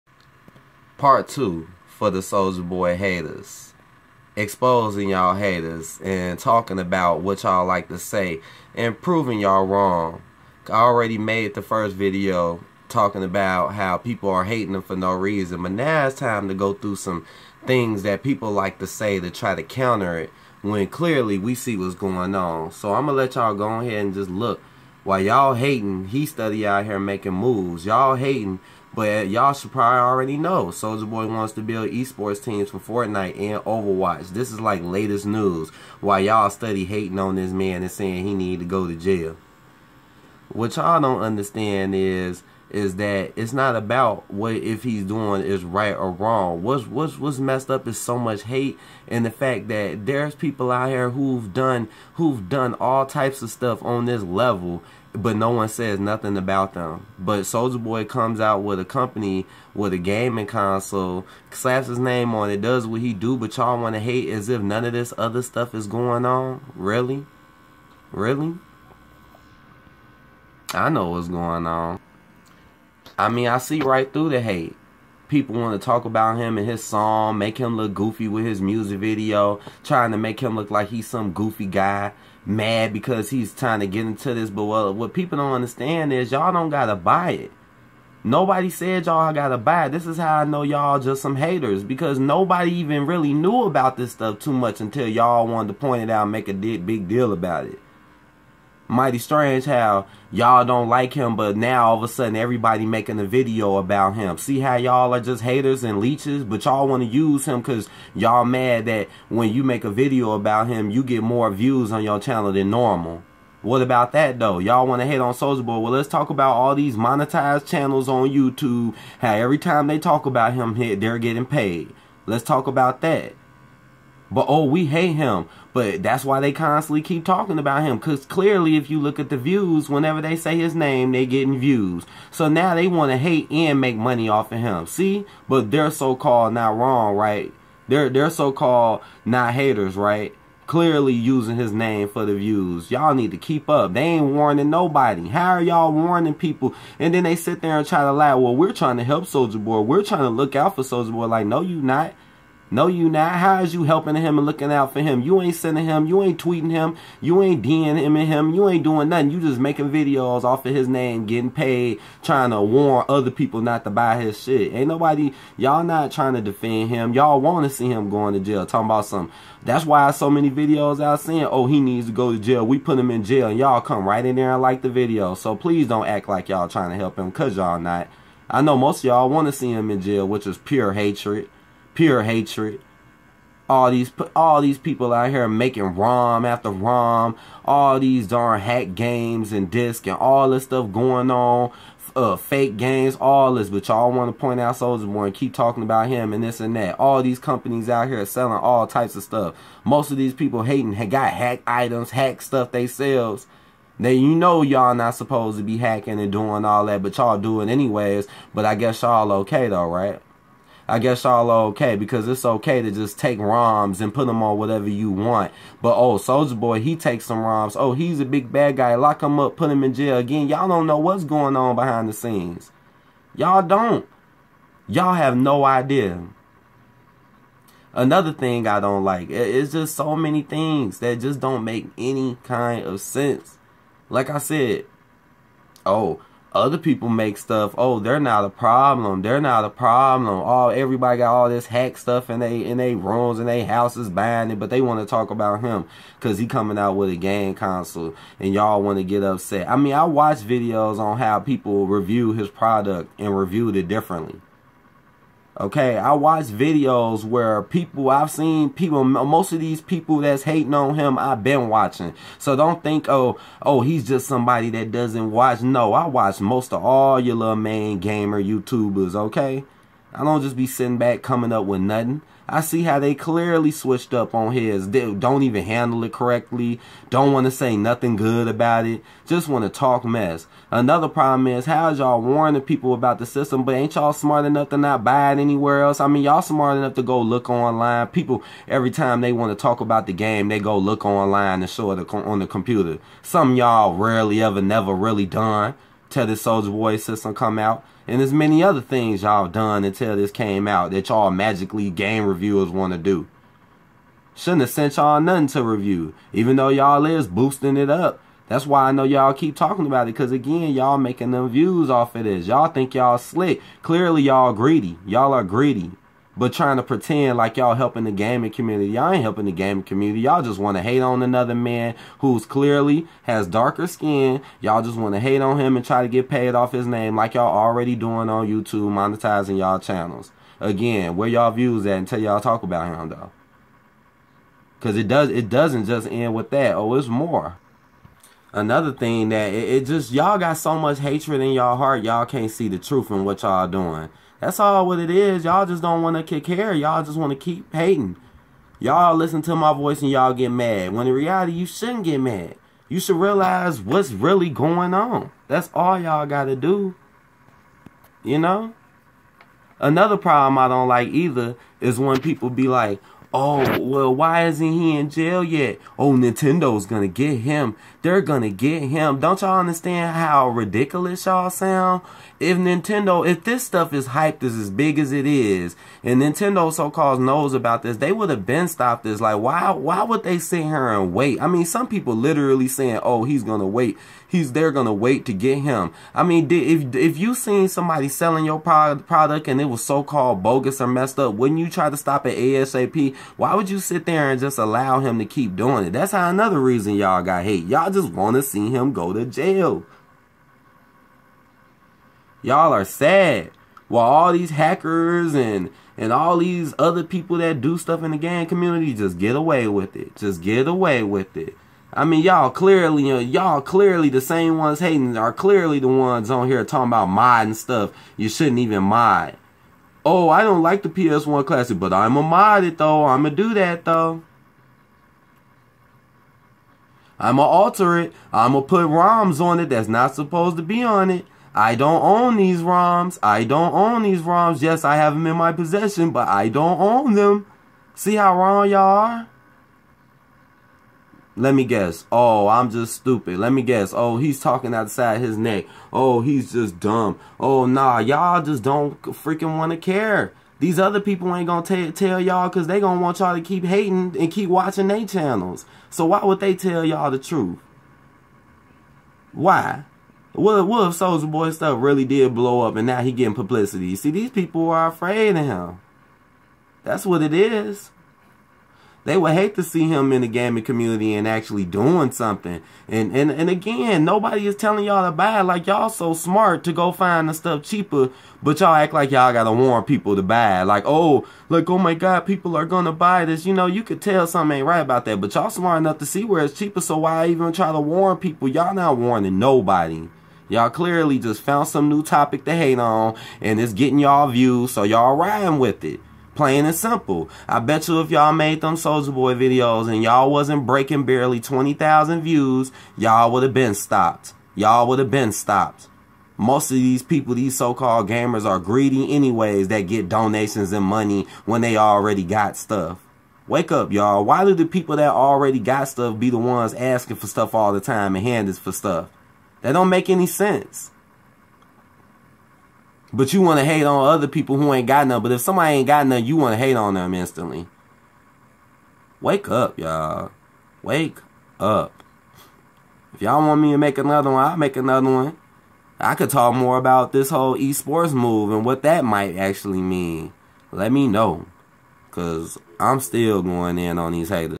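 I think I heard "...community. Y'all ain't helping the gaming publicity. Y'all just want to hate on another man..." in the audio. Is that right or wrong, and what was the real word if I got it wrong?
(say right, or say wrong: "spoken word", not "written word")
wrong: "community", not "publicity".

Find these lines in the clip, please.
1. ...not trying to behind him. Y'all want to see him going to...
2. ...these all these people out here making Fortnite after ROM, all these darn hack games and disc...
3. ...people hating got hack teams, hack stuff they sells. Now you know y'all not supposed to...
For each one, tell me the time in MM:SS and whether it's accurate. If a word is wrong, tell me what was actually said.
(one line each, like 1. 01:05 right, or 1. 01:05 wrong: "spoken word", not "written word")
1. 02:45 wrong: "defend", not "behind"
2. 03:03 wrong: "ROM", not "Fortnite"
3. 03:20 wrong: "items", not "teams".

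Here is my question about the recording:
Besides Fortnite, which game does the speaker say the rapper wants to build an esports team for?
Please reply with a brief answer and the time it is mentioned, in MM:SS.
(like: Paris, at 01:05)
Overwatch, at 00:33.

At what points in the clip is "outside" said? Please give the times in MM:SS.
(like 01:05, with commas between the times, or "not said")
07:24.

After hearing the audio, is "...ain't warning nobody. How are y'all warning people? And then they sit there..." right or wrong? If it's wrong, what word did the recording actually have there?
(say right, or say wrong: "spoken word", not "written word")
right.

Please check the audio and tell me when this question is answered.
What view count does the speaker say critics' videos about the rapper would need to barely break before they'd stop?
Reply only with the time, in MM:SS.
08:21.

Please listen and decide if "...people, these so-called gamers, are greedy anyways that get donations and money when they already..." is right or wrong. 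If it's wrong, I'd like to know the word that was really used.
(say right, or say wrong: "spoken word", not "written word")
right.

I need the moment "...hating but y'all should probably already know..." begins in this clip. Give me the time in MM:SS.
00:28.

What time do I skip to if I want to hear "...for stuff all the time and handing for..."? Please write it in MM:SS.
08:37.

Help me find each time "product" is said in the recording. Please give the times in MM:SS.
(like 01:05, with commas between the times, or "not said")
04:12, 06:28.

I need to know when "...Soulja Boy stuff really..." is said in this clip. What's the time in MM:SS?
07:40.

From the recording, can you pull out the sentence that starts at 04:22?
So don't think, oh, oh, he's just somebody that doesn't watch.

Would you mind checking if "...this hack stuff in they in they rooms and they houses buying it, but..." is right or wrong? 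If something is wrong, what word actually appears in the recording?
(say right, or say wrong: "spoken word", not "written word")
right.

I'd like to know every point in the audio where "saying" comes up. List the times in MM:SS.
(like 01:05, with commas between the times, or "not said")
00:37, 02:51, 06:22.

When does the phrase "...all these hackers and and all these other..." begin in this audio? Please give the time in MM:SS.
06:44.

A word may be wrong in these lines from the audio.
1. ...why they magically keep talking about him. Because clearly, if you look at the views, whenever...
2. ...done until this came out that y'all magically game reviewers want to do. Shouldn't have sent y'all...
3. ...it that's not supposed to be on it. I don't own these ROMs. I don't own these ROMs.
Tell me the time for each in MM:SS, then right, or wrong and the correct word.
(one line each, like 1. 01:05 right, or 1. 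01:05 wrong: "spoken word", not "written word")
1. 02:06 wrong: "constantly", not "magically"
2. 04:59 right
3. 07:09 right.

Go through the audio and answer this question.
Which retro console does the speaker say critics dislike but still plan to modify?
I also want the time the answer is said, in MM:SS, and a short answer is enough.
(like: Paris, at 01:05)
PS1 Classic, at 07:00.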